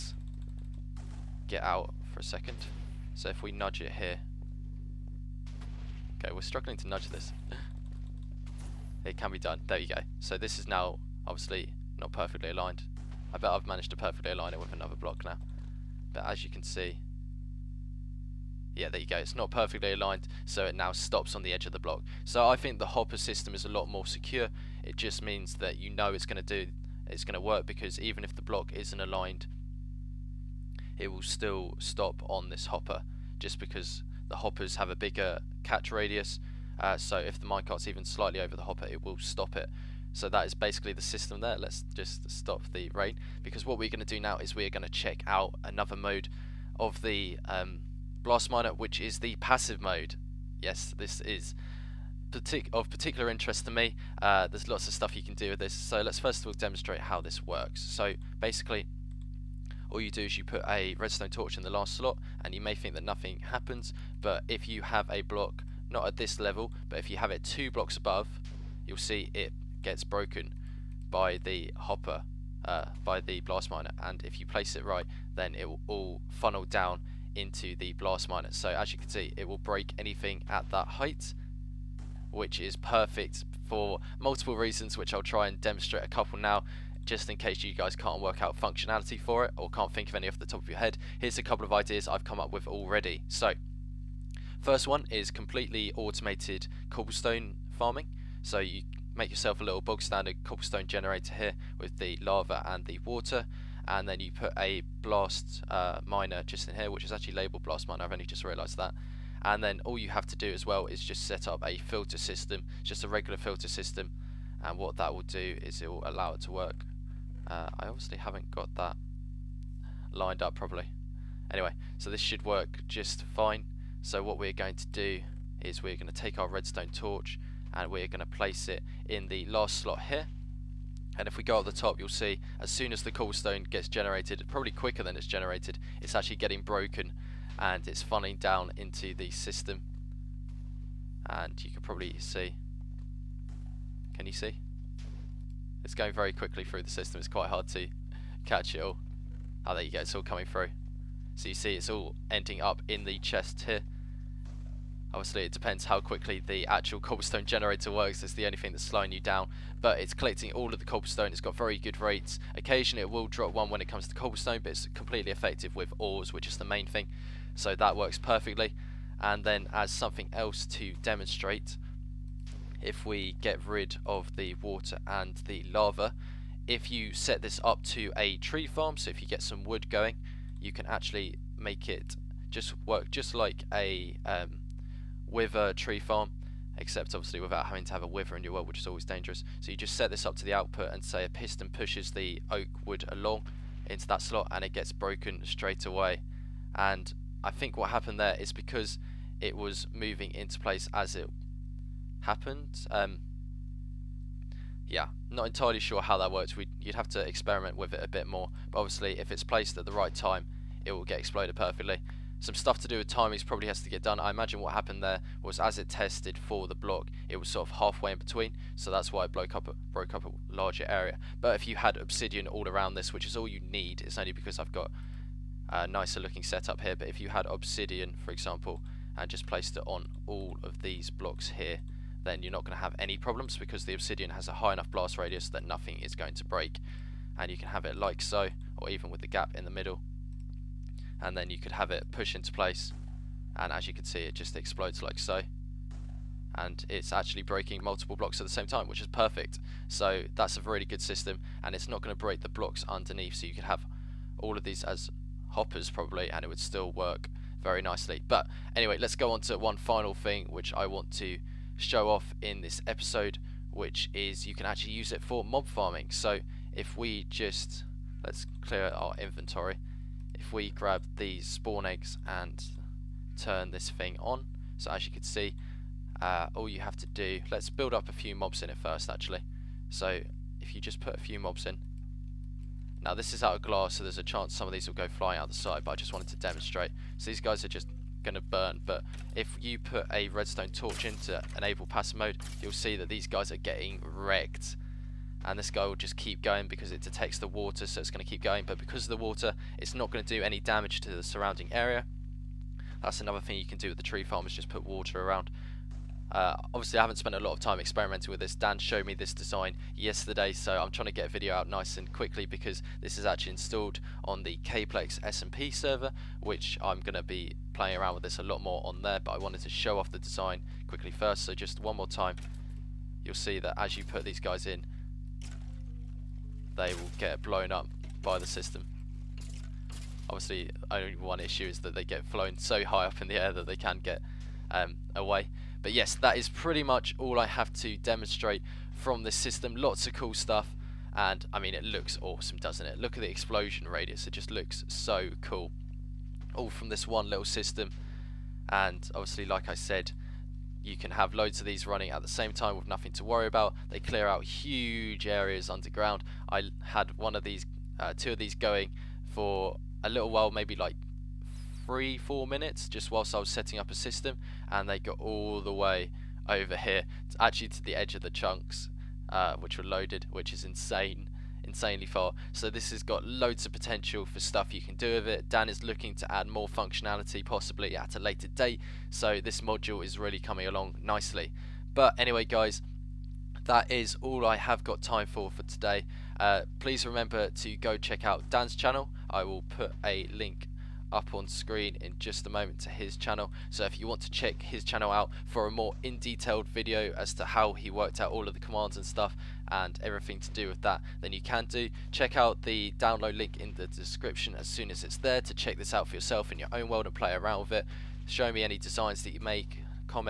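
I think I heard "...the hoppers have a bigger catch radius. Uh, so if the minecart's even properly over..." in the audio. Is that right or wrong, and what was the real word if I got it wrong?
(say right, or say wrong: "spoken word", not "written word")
wrong: "slightly", not "properly".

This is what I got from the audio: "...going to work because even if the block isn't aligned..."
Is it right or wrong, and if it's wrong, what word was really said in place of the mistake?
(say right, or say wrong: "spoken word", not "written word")
right.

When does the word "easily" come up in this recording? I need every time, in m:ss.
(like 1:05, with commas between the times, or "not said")
not said.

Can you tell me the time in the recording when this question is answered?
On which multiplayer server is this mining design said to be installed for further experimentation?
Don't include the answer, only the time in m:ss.
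5:14.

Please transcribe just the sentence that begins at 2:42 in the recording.
Occasionally, it will drop one when it comes to cobblestone, but it's completely effective with ores, which is the main thing.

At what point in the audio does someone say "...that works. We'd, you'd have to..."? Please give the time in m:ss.
3:26.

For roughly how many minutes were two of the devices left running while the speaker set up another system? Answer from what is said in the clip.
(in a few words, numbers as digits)
3 or 4.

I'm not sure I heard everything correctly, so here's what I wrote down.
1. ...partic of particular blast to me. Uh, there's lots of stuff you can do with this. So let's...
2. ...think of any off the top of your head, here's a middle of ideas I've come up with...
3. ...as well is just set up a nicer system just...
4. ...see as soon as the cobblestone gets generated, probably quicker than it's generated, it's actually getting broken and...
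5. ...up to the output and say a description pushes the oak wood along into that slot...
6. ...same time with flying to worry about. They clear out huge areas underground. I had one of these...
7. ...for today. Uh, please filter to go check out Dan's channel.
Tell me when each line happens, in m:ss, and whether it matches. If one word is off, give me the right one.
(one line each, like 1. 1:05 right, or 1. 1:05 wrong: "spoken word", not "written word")
1. 0:52 wrong: "interest", not "blast"
2. 1:29 wrong: "couple", not "middle"
3. 1:50 wrong: "filter", not "nicer"
4. 2:12 right
5. 3:10 wrong: "piston", not "description"
6. 5:52 wrong: "nothing", not "flying"
7. 6:25 wrong: "remember", not "filter".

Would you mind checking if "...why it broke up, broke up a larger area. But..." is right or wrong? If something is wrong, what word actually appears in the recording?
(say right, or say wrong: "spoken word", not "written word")
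right.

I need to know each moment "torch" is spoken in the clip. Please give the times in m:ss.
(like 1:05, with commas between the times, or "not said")
1:01, 2:06, 4:50.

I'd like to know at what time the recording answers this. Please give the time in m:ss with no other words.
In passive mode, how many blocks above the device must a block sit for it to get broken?
1:07.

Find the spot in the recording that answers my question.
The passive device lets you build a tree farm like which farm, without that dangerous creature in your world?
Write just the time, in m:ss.
3:05.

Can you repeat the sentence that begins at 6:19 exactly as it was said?
So this module is really coming along nicely.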